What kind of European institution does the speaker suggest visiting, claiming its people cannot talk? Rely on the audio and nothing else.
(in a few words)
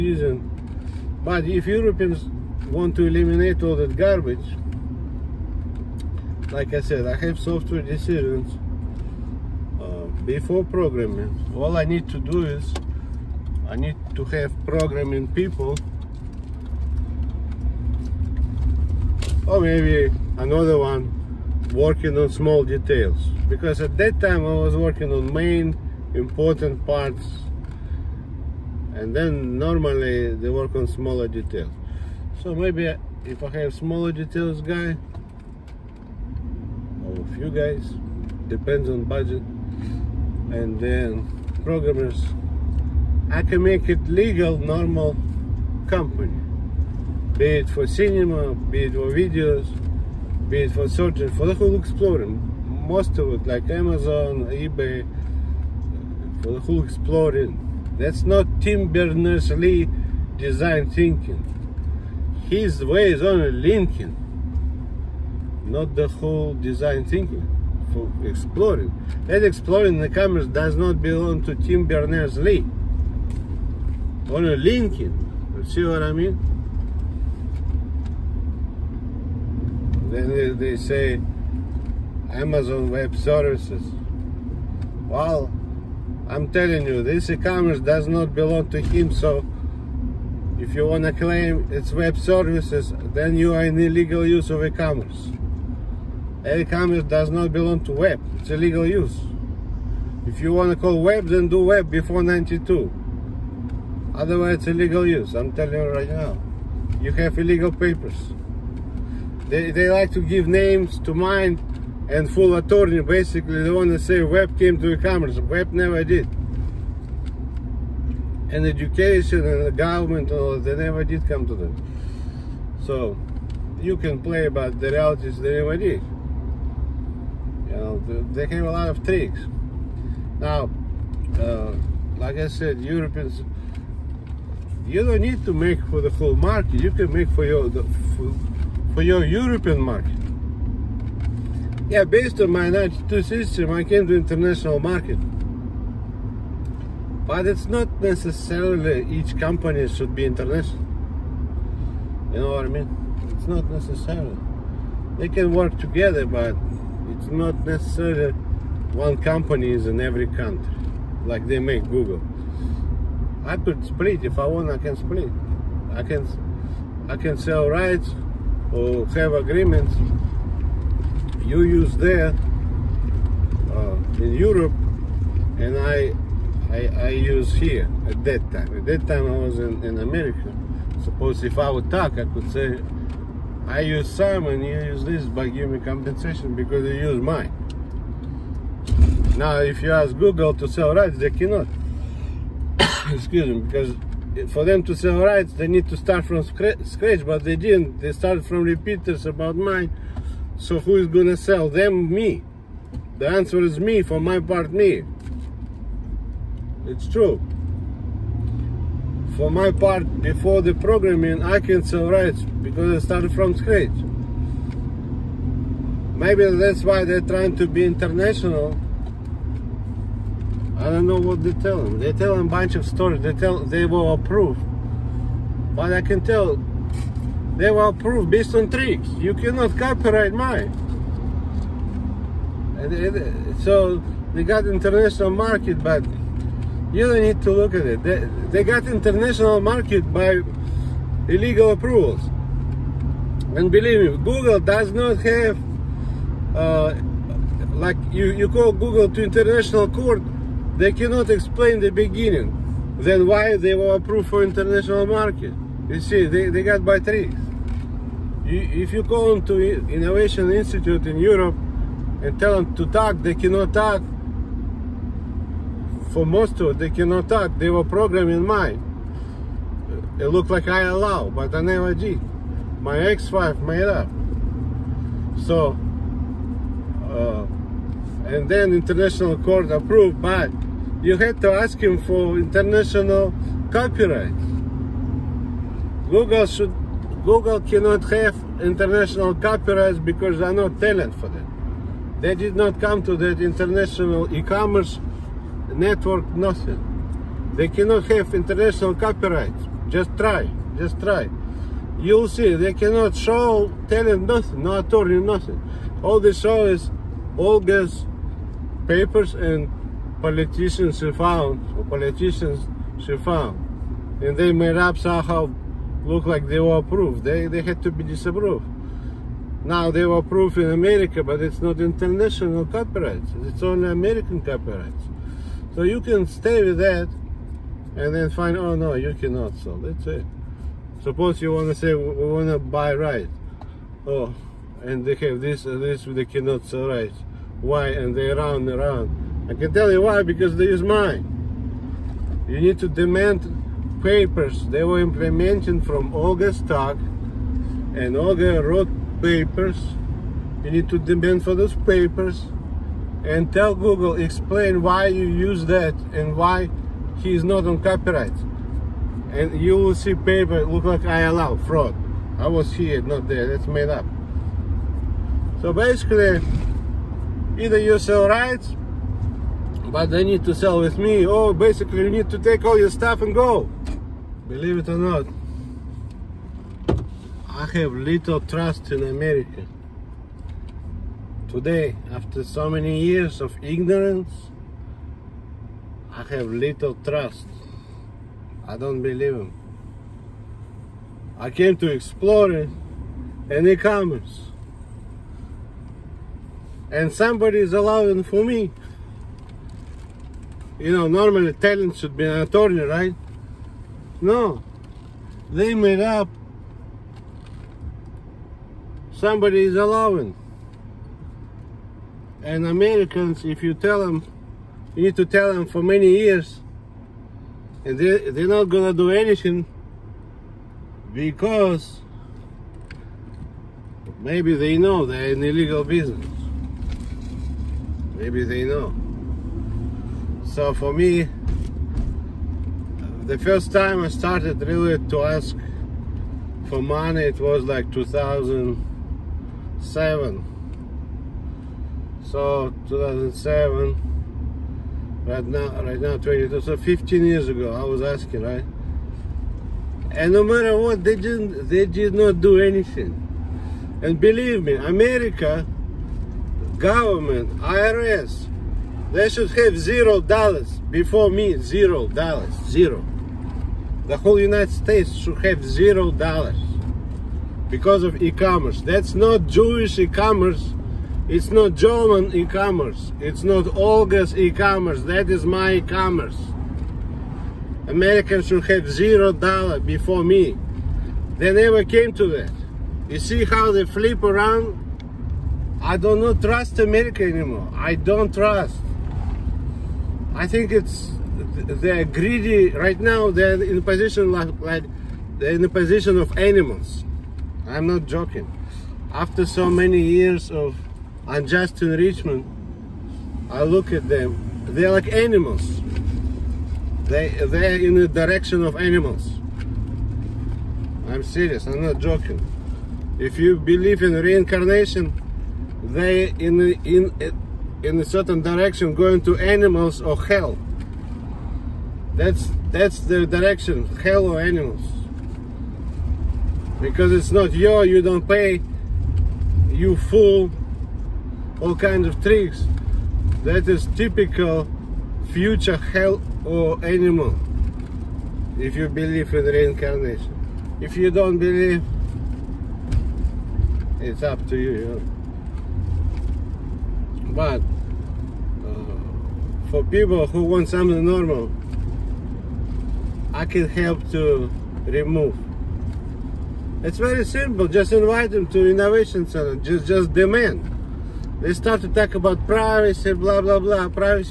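Innovation Institute.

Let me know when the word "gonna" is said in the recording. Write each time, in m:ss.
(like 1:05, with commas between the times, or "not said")
3:21, 6:58.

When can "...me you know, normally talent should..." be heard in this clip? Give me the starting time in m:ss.
6:38.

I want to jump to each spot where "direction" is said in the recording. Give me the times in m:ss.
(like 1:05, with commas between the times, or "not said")
8:28, 8:38, 8:43.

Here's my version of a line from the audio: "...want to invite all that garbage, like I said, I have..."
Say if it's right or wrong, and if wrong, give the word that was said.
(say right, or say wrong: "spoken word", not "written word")
wrong: "eliminate", not "invite".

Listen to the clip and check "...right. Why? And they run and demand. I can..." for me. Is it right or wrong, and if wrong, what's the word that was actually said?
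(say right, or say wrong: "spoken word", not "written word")
wrong: "round", not "demand".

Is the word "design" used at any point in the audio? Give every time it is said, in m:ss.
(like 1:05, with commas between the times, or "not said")
1:00, 1:06.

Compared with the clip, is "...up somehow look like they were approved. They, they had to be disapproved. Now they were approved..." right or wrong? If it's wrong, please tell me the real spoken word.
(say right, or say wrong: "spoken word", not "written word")
right.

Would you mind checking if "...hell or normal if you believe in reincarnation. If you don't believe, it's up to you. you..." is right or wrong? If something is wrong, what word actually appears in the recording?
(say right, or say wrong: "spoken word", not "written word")
wrong: "animal", not "normal".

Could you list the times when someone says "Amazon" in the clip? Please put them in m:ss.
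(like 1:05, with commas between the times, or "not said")
0:53, 1:22.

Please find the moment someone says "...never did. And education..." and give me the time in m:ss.
1:55.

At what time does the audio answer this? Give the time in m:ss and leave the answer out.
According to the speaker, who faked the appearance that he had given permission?
4:32.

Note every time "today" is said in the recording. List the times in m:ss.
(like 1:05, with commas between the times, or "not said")
6:21.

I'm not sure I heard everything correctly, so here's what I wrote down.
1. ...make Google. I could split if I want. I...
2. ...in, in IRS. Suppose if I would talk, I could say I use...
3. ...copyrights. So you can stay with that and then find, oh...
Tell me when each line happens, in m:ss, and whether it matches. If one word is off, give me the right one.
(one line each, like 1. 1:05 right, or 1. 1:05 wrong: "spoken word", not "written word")
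1. 2:41 right
2. 2:59 wrong: "America", not "IRS"
3. 5:24 right.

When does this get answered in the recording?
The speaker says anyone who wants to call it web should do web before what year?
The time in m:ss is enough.
1:41.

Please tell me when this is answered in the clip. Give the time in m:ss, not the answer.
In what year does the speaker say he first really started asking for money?
7:17.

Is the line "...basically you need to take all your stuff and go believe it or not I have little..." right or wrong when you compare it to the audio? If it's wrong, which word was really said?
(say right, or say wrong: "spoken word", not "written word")
right.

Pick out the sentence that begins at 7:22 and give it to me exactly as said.
So 2007, right now, right now 22, so 15 years ago, I was asking, right?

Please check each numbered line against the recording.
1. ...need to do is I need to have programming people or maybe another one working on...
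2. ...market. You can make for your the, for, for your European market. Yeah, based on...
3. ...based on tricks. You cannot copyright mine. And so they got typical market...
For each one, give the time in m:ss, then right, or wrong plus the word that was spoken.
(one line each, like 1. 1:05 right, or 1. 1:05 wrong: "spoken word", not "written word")
1. 0:11 right
2. 2:16 right
3. 3:48 wrong: "international", not "typical".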